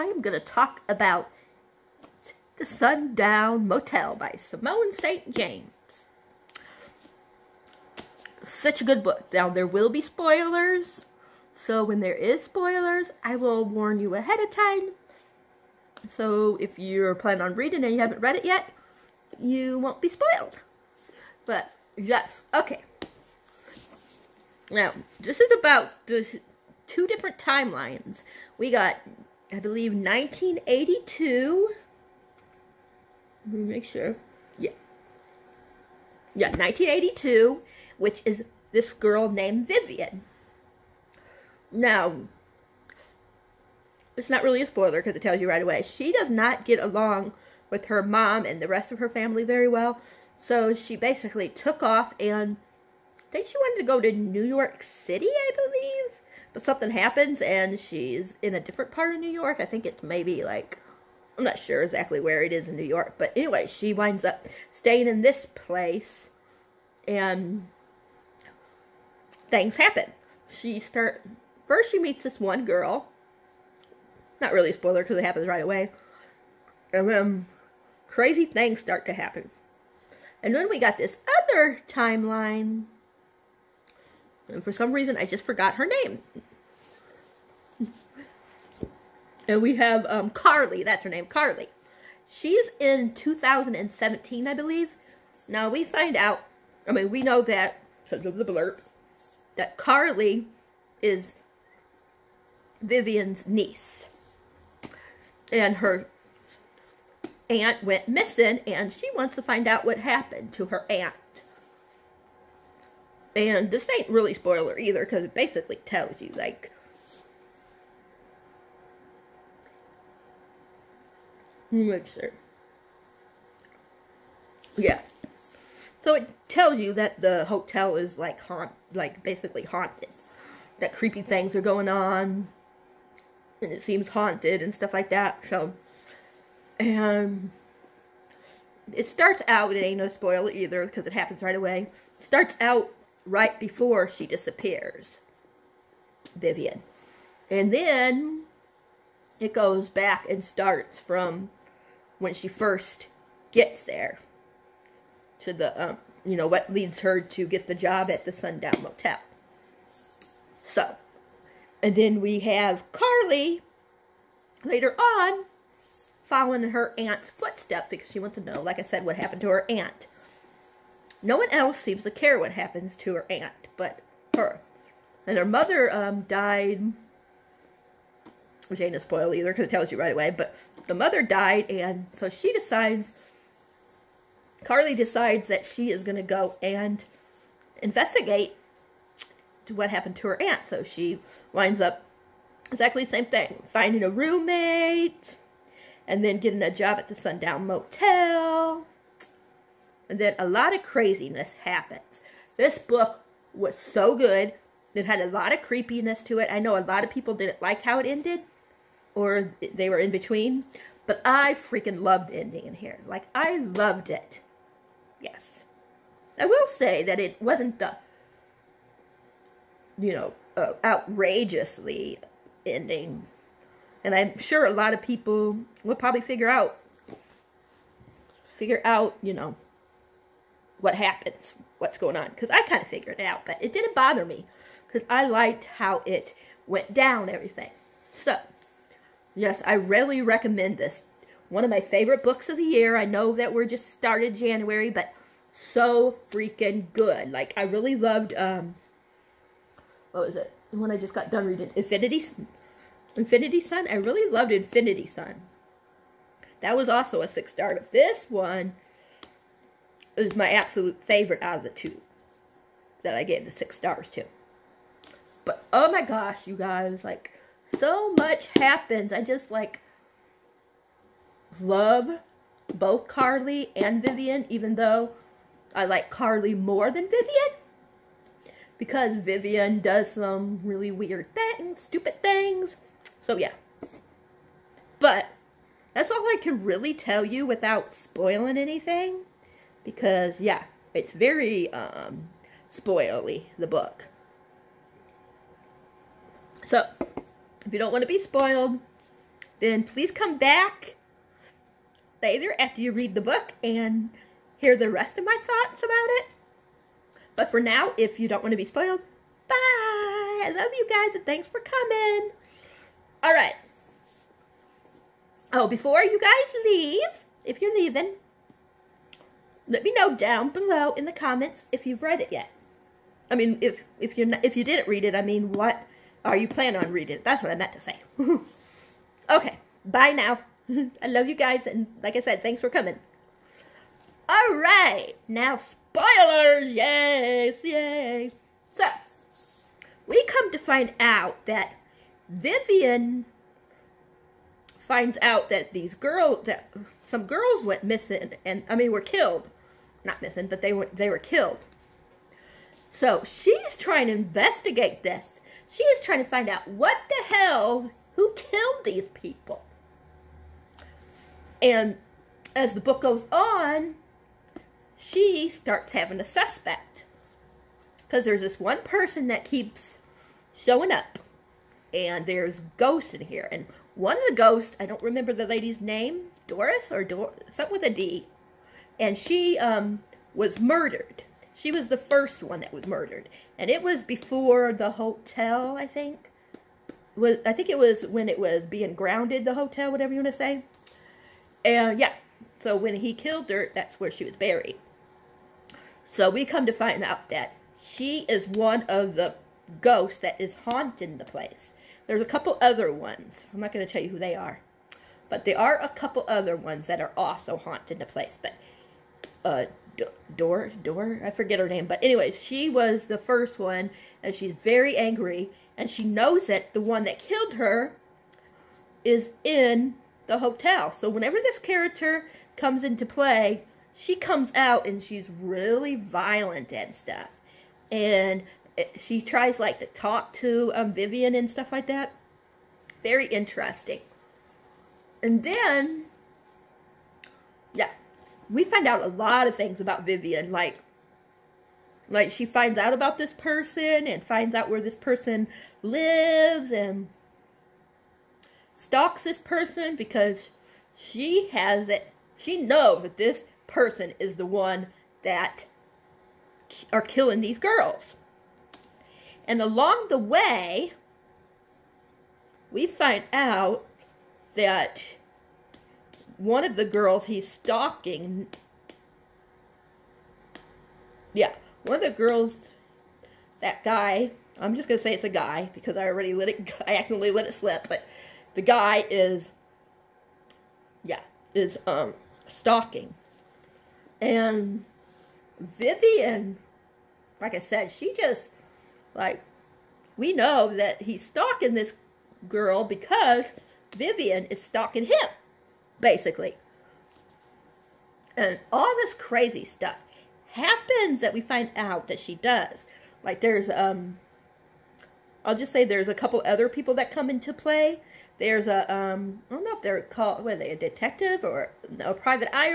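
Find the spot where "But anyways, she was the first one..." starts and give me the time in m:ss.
6:51.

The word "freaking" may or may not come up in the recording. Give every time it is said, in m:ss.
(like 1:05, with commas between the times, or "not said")
3:31, 4:06.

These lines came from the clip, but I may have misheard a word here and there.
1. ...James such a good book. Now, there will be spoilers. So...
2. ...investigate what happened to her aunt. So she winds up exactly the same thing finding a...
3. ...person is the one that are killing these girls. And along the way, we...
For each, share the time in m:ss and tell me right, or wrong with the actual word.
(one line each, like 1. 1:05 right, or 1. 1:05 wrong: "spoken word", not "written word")
1. 0:05 right
2. 3:07 right
3. 7:33 right.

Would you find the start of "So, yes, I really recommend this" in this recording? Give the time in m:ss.
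3:58.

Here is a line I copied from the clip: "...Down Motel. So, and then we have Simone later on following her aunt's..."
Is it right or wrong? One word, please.
wrong.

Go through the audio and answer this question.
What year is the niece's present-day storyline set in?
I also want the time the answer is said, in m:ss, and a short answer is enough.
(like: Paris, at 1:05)
2017, at 1:33.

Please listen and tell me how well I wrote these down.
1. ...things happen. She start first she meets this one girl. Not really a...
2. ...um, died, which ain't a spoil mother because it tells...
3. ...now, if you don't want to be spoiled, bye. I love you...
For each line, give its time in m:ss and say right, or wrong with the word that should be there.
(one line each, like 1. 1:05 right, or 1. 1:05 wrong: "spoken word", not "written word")
1. 1:09 right
2. 2:55 wrong: "either", not "mother"
3. 5:07 right.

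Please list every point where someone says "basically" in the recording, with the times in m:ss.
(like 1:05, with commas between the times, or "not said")
0:50, 1:55, 2:09, 8:16.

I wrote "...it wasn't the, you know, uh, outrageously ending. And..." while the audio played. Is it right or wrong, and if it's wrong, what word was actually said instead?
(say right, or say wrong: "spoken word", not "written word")
right.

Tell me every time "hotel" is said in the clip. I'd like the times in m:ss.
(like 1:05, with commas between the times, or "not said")
2:07, 6:24, 6:29, 7:00.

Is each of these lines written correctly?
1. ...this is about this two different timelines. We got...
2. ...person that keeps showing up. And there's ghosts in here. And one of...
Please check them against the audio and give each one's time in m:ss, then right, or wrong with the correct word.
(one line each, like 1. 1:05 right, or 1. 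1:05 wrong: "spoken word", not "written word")
1. 0:25 right
2. 6:08 right.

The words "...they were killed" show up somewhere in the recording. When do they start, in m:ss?
5:50.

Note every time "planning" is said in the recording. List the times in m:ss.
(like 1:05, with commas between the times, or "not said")
0:17, 5:26.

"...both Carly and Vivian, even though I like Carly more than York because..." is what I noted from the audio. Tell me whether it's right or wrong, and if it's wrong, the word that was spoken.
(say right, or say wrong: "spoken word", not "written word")
wrong: "Vivian", not "York".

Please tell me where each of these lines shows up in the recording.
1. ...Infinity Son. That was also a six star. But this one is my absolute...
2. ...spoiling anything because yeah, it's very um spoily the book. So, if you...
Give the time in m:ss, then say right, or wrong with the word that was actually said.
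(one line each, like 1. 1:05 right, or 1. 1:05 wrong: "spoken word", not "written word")
1. 4:14 right
2. 4:47 right.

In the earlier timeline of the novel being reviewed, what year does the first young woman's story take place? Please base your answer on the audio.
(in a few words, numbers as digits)
1982.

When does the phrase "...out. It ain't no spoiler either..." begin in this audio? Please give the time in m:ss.
2:19.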